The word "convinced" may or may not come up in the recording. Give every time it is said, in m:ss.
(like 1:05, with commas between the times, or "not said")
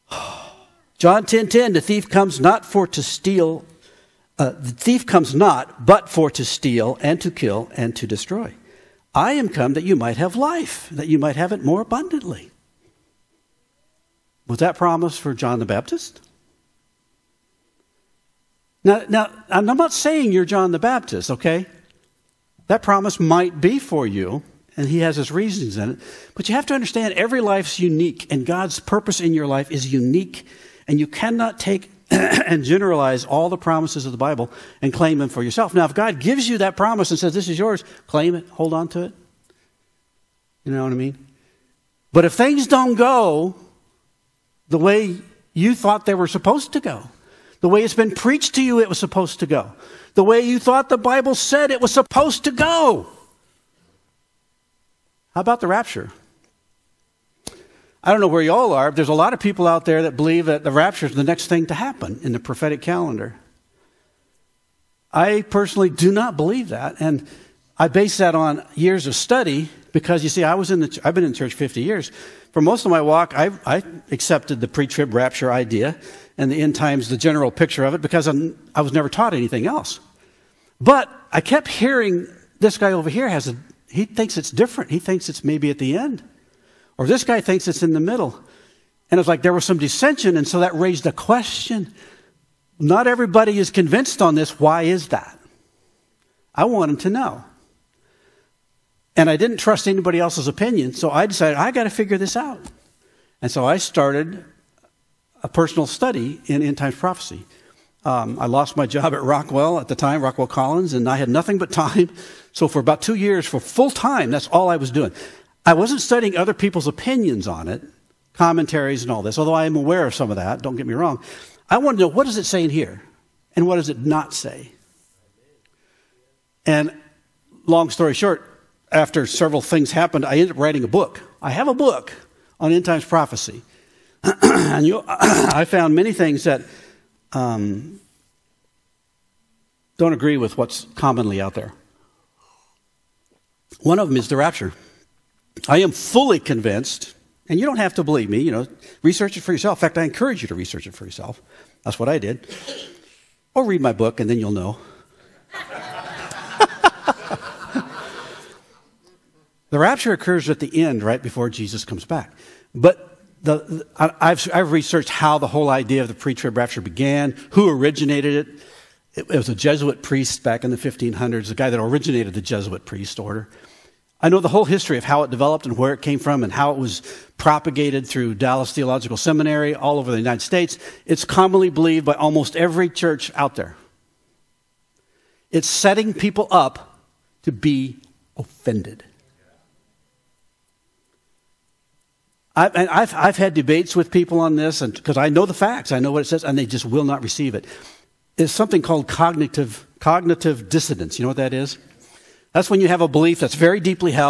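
1:33, 2:26.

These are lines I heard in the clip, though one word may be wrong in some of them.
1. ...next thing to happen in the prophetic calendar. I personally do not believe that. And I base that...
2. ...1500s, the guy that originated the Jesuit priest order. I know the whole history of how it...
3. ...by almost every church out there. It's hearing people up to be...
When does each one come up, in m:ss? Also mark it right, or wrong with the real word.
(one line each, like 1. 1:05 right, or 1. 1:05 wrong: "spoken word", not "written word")
1. 1:01 right
2. 2:50 right
3. 3:02 wrong: "setting", not "hearing".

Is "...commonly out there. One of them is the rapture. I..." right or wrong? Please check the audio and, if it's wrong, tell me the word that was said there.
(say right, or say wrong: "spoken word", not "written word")
right.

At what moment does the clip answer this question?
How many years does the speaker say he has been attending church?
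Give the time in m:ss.
1:11.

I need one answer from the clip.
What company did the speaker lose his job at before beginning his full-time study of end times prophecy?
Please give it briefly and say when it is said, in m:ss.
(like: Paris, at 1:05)
Rockwell Collins, at 1:50.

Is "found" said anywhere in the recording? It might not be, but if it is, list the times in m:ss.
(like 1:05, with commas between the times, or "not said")
2:15.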